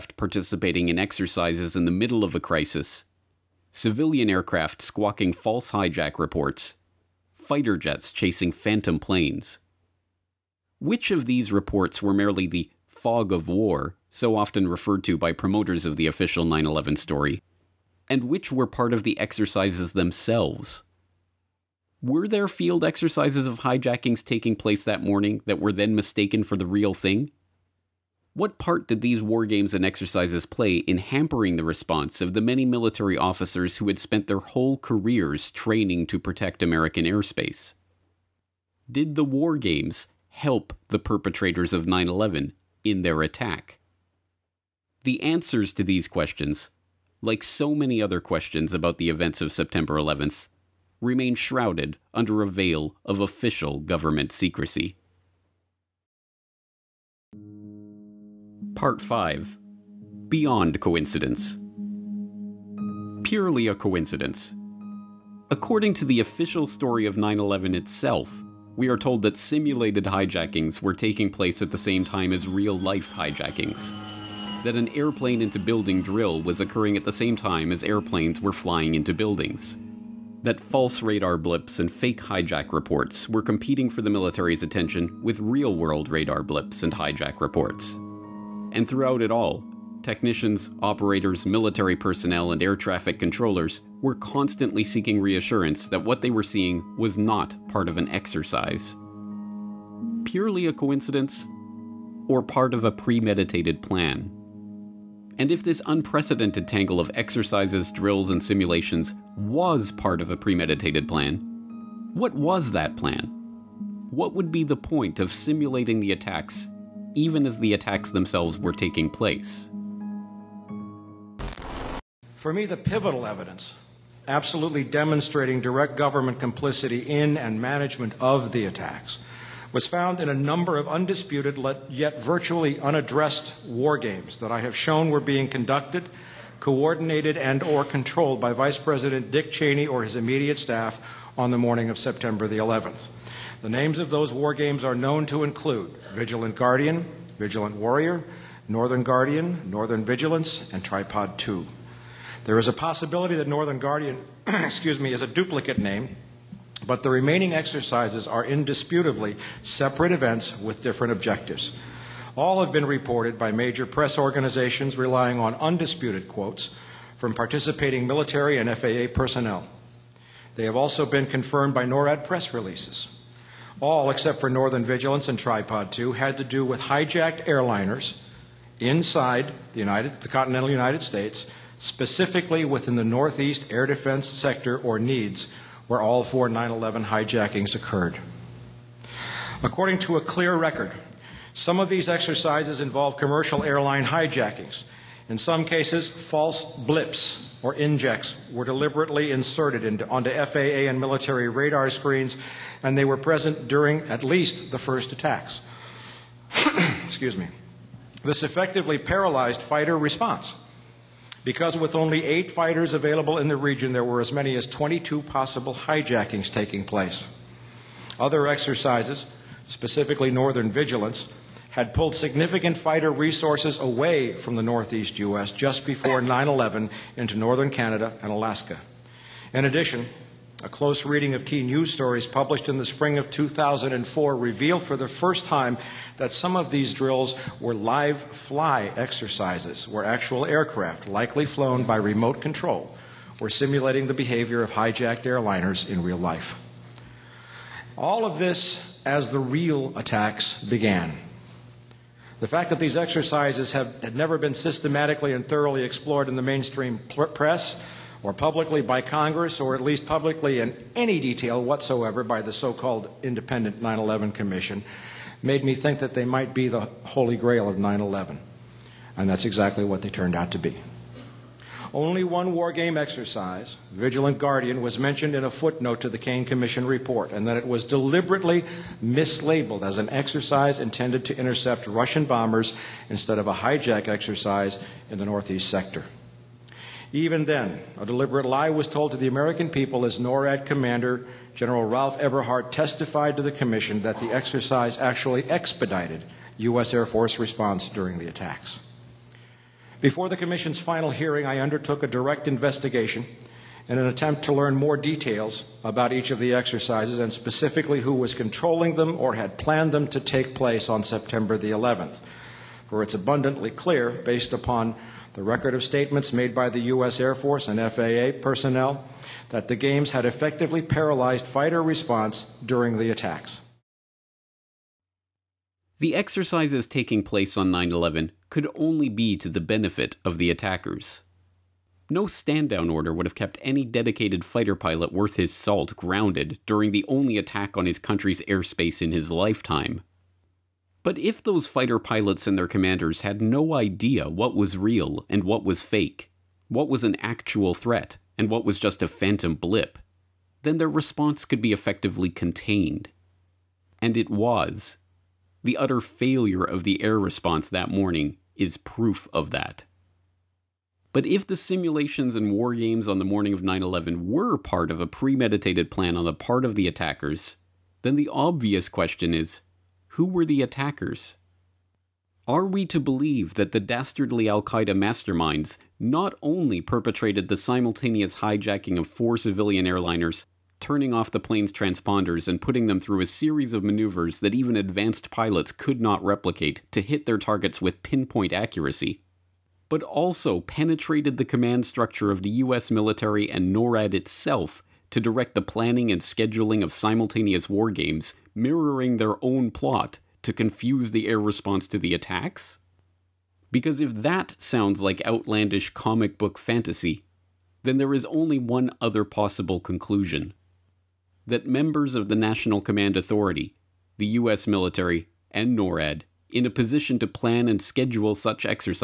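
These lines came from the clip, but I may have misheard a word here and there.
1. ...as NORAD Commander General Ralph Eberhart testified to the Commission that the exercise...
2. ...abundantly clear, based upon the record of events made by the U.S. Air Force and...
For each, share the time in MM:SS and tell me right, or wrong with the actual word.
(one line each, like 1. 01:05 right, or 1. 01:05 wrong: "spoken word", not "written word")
1. 04:50 right
2. 05:13 wrong: "statements", not "events".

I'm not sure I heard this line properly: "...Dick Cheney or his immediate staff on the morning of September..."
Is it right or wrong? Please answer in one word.
right.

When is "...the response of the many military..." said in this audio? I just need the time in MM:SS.
00:31.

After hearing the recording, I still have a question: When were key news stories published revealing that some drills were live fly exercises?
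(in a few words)
spring of 2004.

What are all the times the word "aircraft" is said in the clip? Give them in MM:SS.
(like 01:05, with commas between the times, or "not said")
00:04, 04:00.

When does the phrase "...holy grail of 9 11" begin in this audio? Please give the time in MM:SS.
04:27.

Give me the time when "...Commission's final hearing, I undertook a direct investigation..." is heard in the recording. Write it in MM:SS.
05:00.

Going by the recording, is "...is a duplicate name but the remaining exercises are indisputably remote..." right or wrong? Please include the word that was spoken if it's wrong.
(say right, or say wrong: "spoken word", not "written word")
wrong: "separate", not "remote".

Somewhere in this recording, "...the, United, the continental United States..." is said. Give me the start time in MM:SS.
02:59.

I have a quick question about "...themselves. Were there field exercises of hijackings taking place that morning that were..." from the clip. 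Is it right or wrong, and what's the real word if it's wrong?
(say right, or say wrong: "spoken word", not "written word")
right.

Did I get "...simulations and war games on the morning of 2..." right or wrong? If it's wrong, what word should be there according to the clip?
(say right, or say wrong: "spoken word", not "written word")
wrong: "9", not "2".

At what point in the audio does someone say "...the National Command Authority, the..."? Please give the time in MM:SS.
06:52.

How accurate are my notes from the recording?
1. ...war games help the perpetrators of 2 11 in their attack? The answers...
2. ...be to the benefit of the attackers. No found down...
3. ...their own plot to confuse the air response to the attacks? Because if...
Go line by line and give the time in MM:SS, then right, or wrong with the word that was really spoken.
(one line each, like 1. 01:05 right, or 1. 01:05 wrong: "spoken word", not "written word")
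1. 00:39 wrong: "9", not "2"
2. 05:29 wrong: "stand", not "found"
3. 06:39 right.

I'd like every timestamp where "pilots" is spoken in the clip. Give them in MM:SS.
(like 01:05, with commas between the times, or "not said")
05:34, 05:41, 06:25.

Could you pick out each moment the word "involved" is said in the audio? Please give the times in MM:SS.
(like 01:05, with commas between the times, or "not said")
03:12.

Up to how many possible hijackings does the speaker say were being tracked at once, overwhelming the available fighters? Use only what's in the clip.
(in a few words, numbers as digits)
22.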